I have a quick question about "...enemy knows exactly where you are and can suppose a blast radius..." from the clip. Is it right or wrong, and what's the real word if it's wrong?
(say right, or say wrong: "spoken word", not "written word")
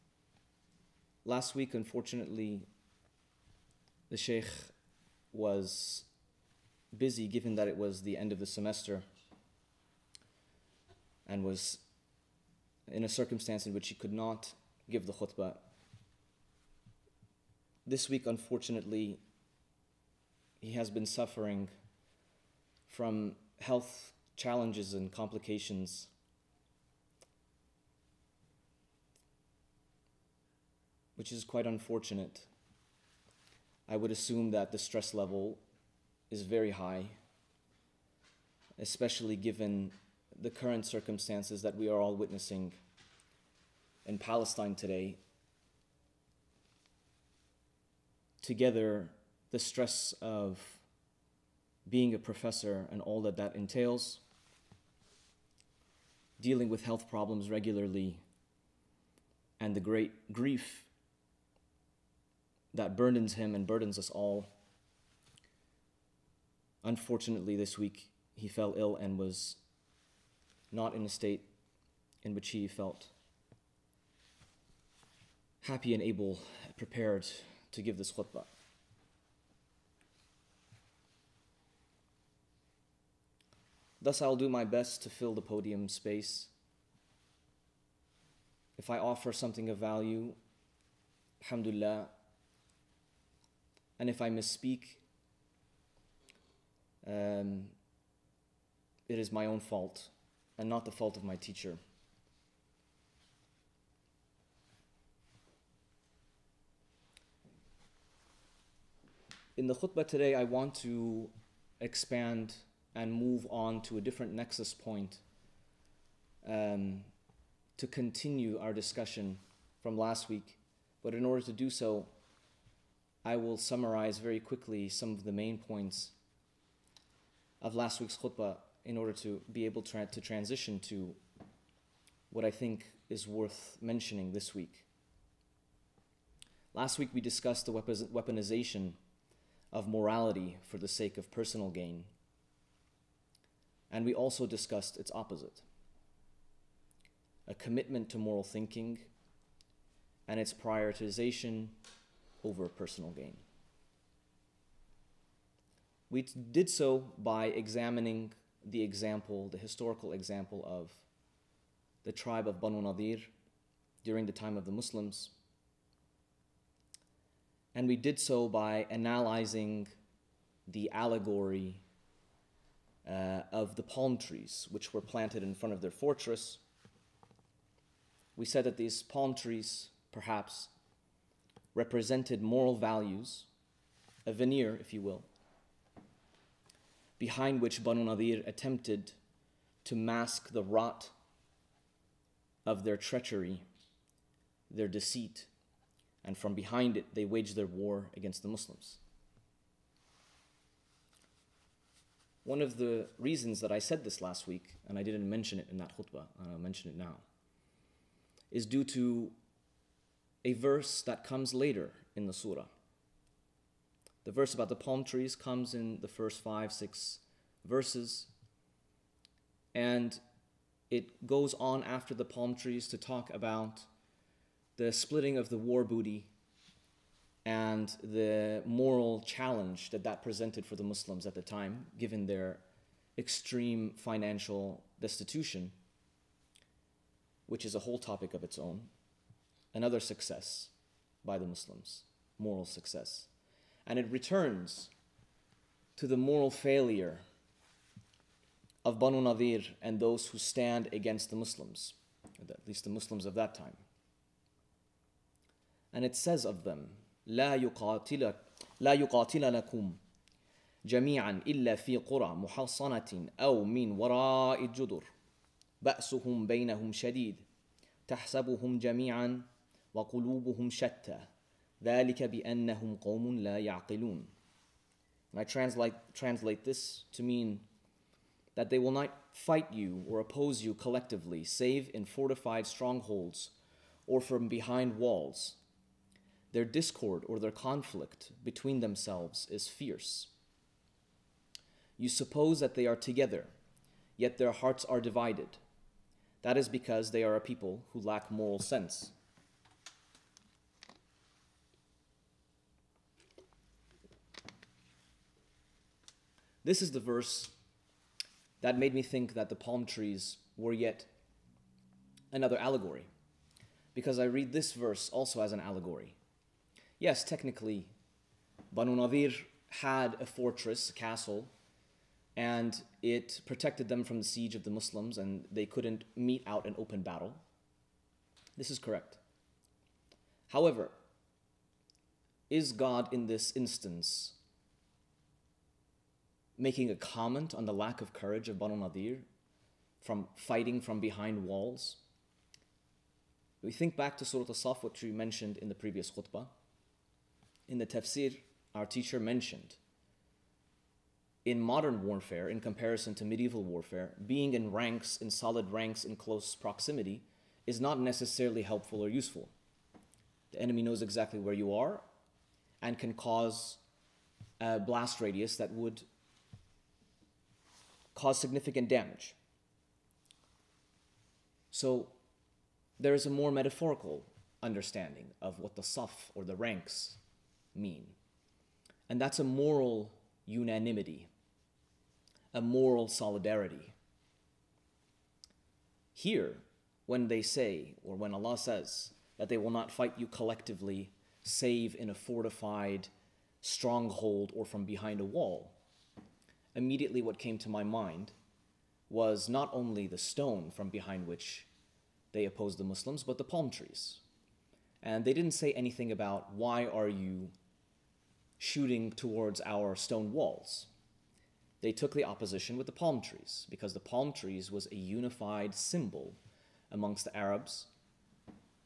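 wrong: "cause", not "suppose".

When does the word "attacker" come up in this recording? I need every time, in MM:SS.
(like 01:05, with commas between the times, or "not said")
not said.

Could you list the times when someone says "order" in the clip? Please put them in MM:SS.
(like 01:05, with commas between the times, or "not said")
02:01, 02:08.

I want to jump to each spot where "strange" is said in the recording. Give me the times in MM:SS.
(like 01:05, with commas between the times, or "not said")
not said.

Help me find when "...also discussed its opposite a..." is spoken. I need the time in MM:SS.
02:24.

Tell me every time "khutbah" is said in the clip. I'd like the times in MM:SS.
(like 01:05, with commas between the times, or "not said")
00:15, 01:18, 01:49, 02:08, 03:25, 05:46.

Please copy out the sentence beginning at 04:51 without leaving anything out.
You suppose that they are together, yet their hearts are divided.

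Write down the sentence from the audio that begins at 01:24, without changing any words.
Thus, I'll do my best to fill the podium space.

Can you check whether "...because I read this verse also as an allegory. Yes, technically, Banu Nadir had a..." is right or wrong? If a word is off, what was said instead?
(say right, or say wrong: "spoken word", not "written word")
right.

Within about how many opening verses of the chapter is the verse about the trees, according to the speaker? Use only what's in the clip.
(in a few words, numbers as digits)
5 or 6.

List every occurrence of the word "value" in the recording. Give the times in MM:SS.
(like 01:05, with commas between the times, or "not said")
01:29, 03:02.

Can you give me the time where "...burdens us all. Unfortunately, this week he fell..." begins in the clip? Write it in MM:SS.
01:03.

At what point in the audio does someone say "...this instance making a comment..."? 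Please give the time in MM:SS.
05:33.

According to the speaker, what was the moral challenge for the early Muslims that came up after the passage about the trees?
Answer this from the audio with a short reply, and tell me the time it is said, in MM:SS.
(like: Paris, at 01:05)
splitting of the war booty, at 03:44.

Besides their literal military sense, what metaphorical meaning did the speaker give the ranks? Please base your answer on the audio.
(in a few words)
moral solidarity.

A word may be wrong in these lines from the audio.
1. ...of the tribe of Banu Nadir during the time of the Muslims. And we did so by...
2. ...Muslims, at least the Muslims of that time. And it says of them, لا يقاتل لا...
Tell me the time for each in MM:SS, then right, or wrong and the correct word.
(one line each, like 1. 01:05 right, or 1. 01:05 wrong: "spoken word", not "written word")
1. 02:40 right
2. 04:11 right.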